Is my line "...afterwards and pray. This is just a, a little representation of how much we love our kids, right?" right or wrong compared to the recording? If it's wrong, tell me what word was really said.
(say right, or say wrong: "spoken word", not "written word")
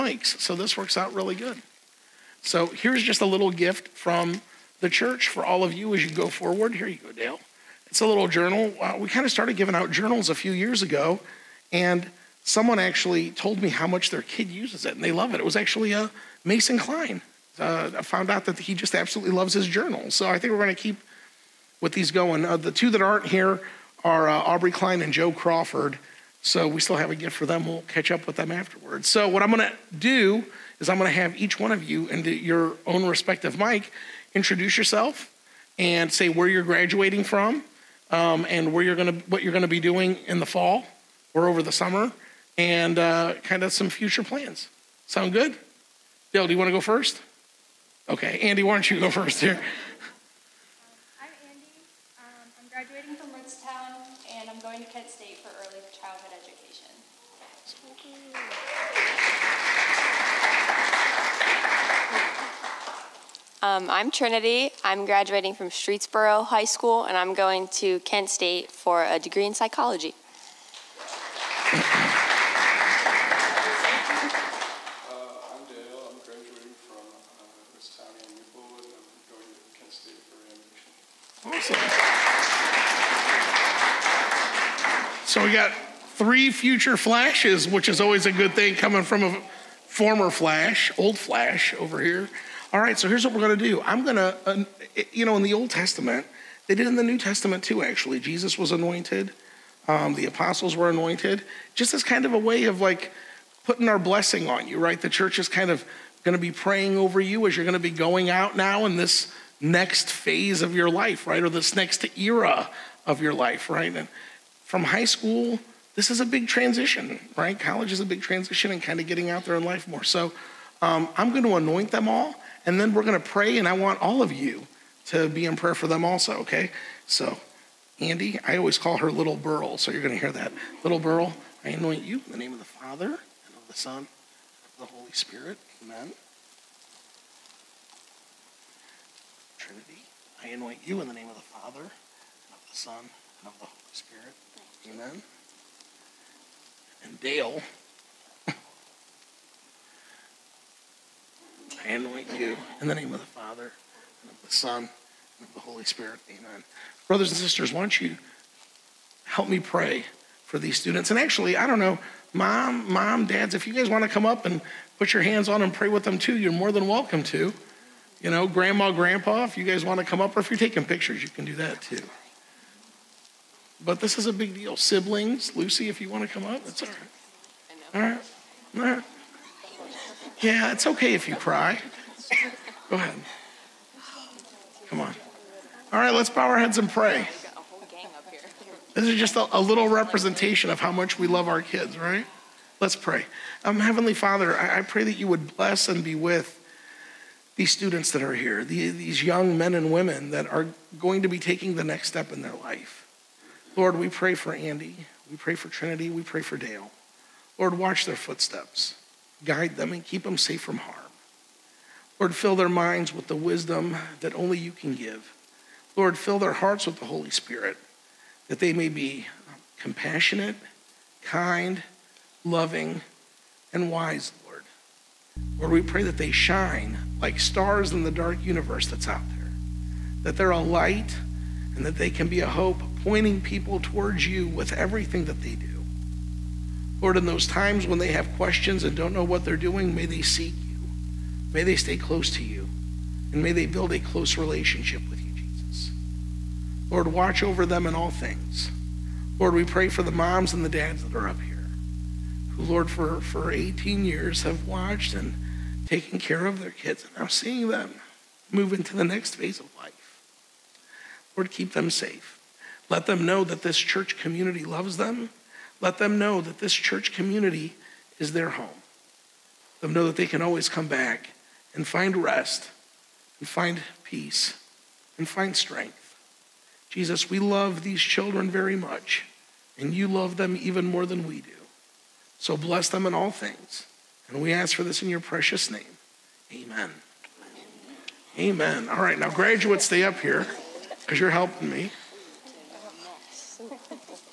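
wrong: "heads", not "afterwards".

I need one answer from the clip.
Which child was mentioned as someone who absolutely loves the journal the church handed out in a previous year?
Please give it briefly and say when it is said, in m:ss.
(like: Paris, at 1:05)
Mason Klein, at 0:16.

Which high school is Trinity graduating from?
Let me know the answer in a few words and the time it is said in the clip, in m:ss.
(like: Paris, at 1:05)
Streetsboro High School, at 1:05.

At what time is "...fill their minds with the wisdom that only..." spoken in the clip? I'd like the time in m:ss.
3:32.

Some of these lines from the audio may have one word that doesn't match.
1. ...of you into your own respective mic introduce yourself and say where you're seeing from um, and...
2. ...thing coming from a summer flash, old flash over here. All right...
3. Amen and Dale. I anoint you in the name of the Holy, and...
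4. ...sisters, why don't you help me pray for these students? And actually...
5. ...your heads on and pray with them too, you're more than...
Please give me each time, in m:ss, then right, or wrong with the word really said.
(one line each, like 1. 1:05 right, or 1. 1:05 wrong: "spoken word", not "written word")
1. 0:31 wrong: "graduating", not "seeing"
2. 1:28 wrong: "former", not "summer"
3. 2:24 wrong: "Father", not "Holy"
4. 2:37 right
5. 2:45 wrong: "hands", not "heads".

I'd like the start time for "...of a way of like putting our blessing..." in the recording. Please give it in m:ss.
1:42.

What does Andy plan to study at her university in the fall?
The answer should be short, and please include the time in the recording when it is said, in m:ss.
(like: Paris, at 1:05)
Early childhood education, at 0:55.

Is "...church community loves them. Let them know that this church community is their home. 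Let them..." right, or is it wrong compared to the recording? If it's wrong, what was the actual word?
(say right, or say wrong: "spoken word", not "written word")
right.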